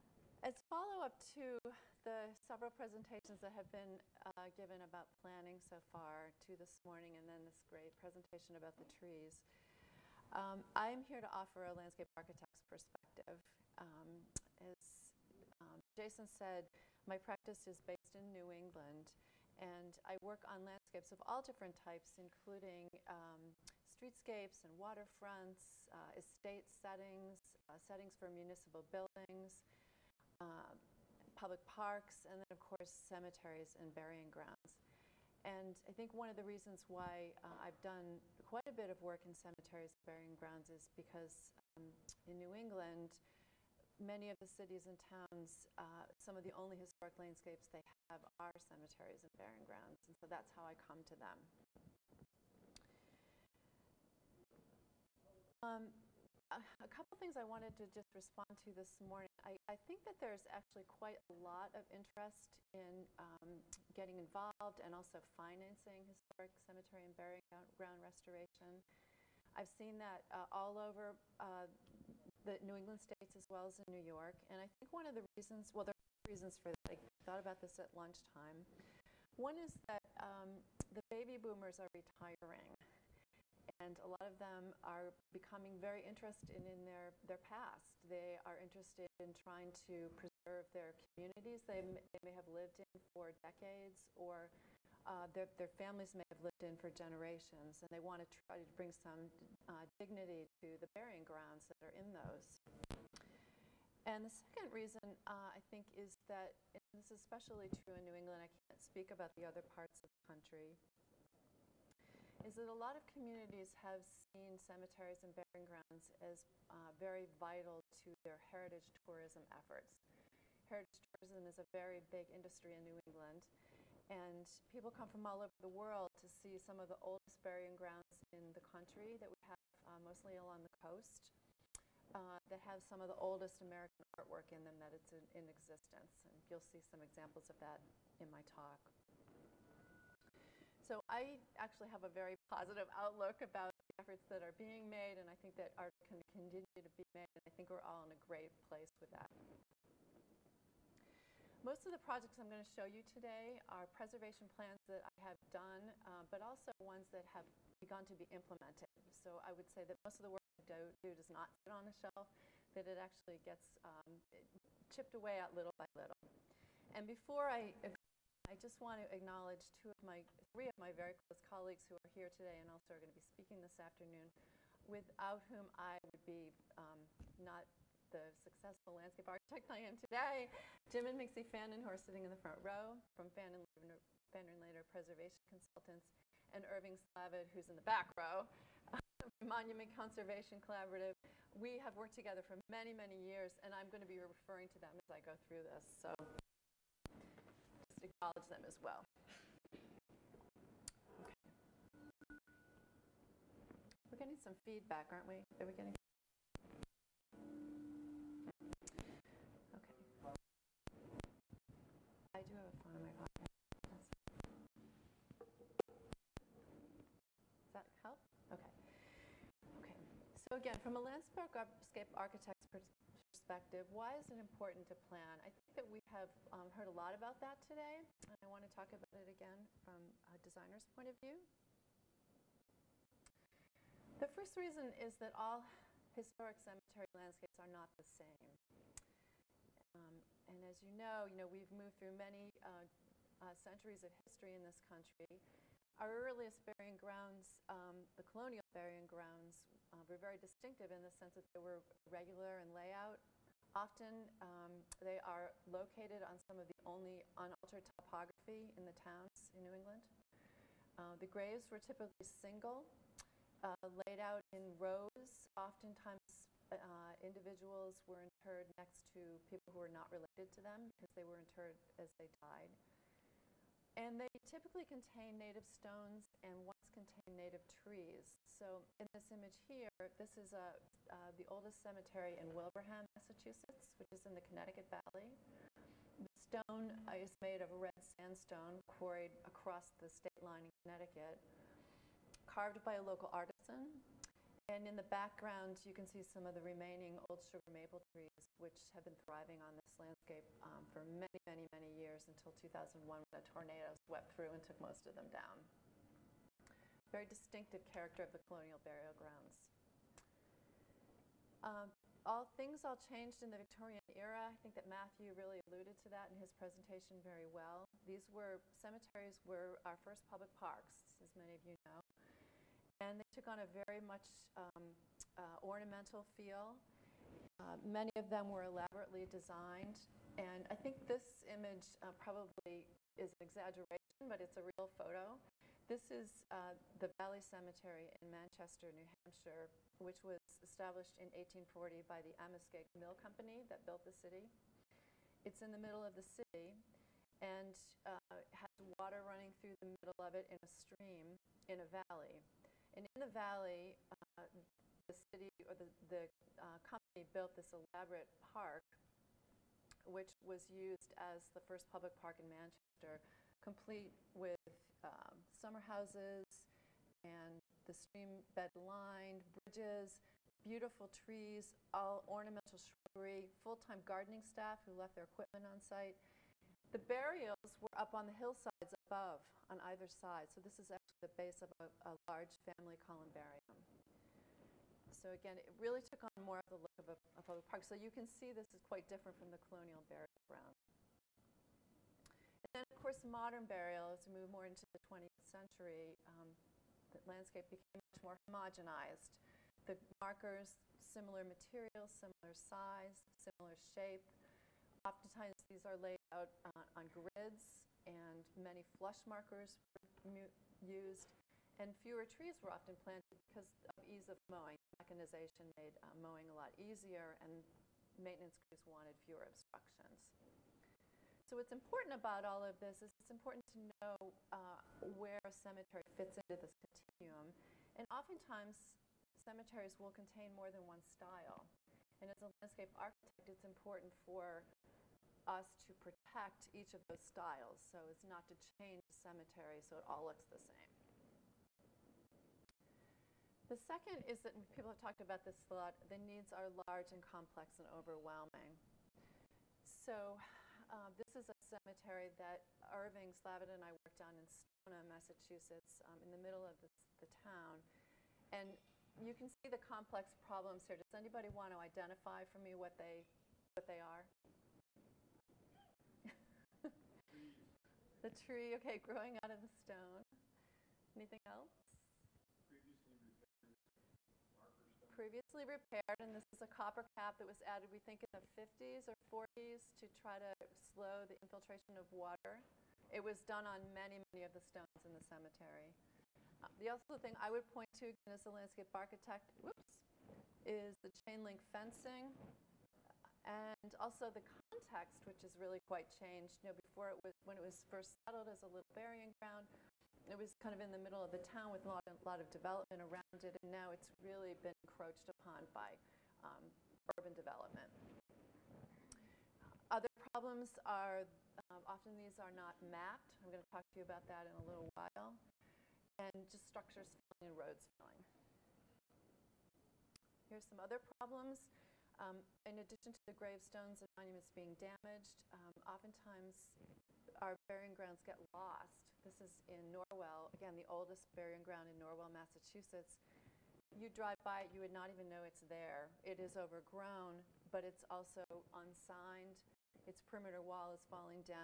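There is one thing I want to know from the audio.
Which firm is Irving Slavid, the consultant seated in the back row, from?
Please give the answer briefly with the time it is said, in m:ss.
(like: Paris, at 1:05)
Monument Conservation Collaborative, at 3:09.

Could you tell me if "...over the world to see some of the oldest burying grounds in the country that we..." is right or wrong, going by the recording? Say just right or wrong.
right.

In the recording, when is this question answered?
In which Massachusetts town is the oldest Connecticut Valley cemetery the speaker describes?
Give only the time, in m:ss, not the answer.
4:42.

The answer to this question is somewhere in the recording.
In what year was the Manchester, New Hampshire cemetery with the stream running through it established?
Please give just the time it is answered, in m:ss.
5:41.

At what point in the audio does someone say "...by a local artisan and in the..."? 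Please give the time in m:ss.
4:52.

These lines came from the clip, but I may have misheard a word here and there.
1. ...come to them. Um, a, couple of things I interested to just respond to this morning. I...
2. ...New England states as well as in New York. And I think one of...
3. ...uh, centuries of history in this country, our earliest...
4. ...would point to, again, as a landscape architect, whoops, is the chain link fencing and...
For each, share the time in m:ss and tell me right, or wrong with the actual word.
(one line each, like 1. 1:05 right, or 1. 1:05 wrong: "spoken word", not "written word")
1. 0:50 wrong: "wanted", not "interested"
2. 1:12 right
3. 4:03 right
4. 8:07 right.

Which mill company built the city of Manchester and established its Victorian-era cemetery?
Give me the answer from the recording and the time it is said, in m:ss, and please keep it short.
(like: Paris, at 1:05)
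Amoskeag Mill Company, at 5:42.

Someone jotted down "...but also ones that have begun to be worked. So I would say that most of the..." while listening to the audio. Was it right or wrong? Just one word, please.
wrong.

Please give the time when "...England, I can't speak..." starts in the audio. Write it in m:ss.
1:48.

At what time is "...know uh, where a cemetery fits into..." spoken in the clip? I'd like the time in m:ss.
7:03.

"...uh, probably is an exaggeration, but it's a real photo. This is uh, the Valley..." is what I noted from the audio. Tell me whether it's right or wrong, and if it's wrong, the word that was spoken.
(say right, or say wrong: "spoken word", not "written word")
right.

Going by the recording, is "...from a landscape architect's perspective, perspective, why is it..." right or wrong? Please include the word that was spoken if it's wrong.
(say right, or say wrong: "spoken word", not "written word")
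right.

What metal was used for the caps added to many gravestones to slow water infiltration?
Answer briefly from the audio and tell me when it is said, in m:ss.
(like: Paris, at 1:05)
copper, at 7:56.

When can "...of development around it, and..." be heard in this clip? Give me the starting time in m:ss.
8:22.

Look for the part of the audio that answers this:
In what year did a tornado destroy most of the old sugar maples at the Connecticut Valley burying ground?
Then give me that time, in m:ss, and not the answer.
5:02.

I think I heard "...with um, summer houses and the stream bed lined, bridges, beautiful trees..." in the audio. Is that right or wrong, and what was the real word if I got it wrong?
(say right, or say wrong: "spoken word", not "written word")
right.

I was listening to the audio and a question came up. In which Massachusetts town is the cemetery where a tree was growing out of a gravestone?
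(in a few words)
Stoneham.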